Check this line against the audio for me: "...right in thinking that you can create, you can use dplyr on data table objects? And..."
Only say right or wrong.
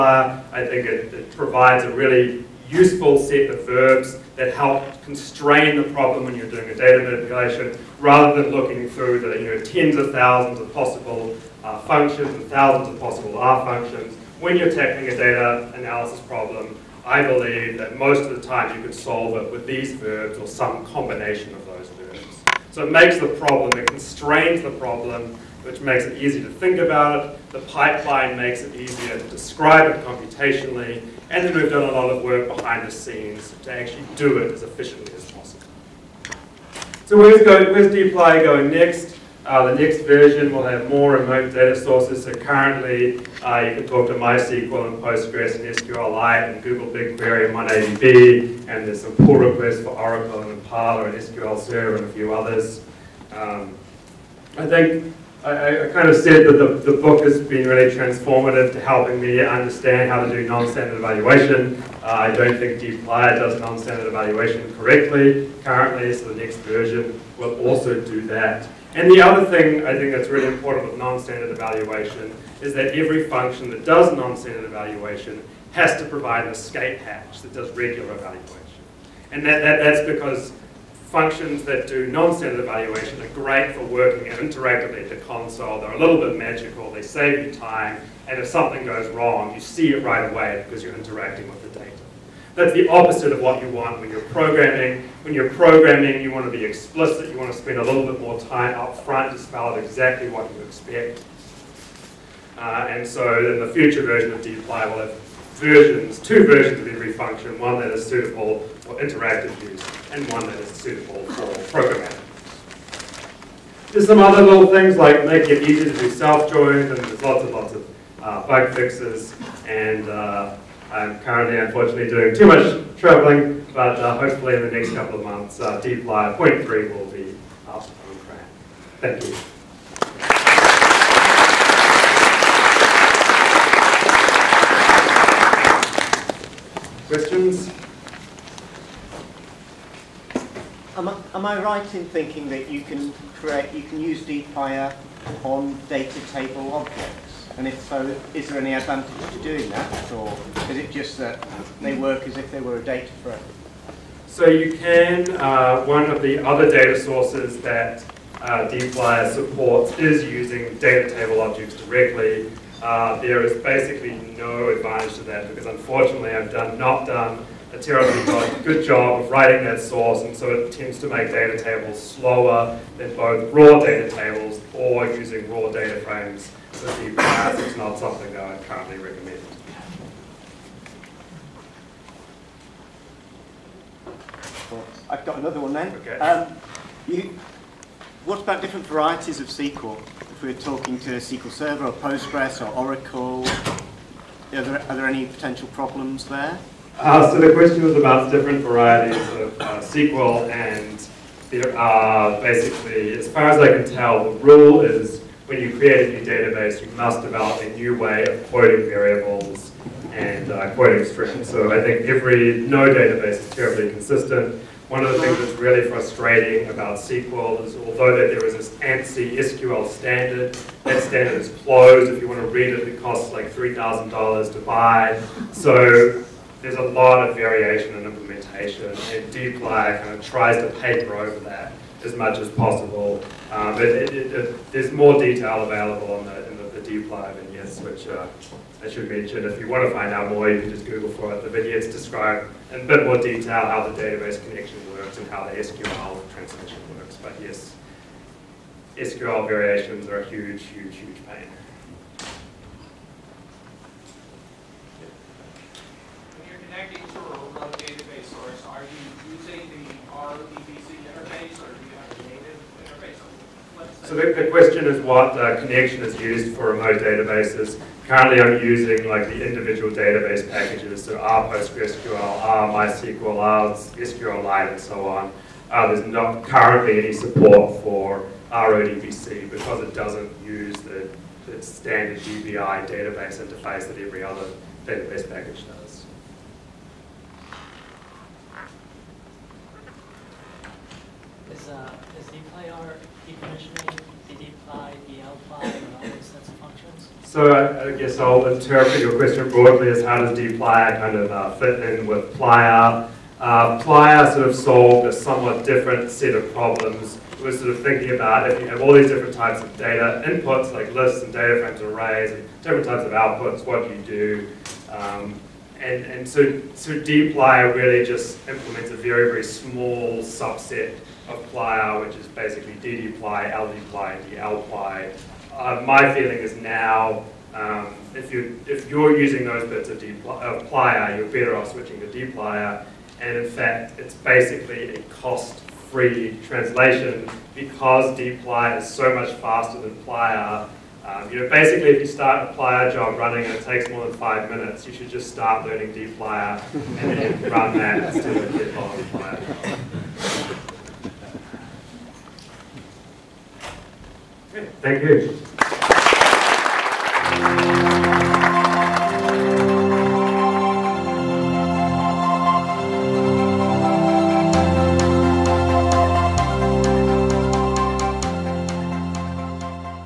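right.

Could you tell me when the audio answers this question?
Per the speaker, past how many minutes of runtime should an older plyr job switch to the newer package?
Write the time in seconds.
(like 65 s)
344 s.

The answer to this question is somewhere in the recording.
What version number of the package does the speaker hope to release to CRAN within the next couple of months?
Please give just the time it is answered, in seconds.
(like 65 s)
125 s.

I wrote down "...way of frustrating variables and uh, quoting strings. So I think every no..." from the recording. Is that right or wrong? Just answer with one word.
wrong.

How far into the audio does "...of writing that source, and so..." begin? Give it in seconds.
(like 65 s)
169 s.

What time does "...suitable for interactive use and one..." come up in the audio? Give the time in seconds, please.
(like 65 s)
108 s.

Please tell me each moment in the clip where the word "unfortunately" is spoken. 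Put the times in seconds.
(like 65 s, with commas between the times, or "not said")
121 s, 165 s.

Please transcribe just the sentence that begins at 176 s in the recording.
So DPRs not something that I currently recommend.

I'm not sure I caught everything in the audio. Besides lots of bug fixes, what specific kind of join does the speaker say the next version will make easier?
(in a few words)
self-joins.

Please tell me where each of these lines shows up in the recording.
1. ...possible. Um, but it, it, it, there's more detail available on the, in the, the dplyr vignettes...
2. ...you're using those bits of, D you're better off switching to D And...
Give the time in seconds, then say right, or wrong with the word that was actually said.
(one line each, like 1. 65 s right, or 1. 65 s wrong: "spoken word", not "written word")
1. 232 s right
2. 328 s right.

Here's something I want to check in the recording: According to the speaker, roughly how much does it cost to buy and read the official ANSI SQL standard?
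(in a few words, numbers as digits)
$3,000.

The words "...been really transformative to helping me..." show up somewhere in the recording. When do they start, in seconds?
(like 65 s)
57 s.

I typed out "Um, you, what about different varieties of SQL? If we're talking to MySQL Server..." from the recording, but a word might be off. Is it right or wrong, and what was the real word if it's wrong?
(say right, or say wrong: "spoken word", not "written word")
wrong: "SQL", not "MySQL".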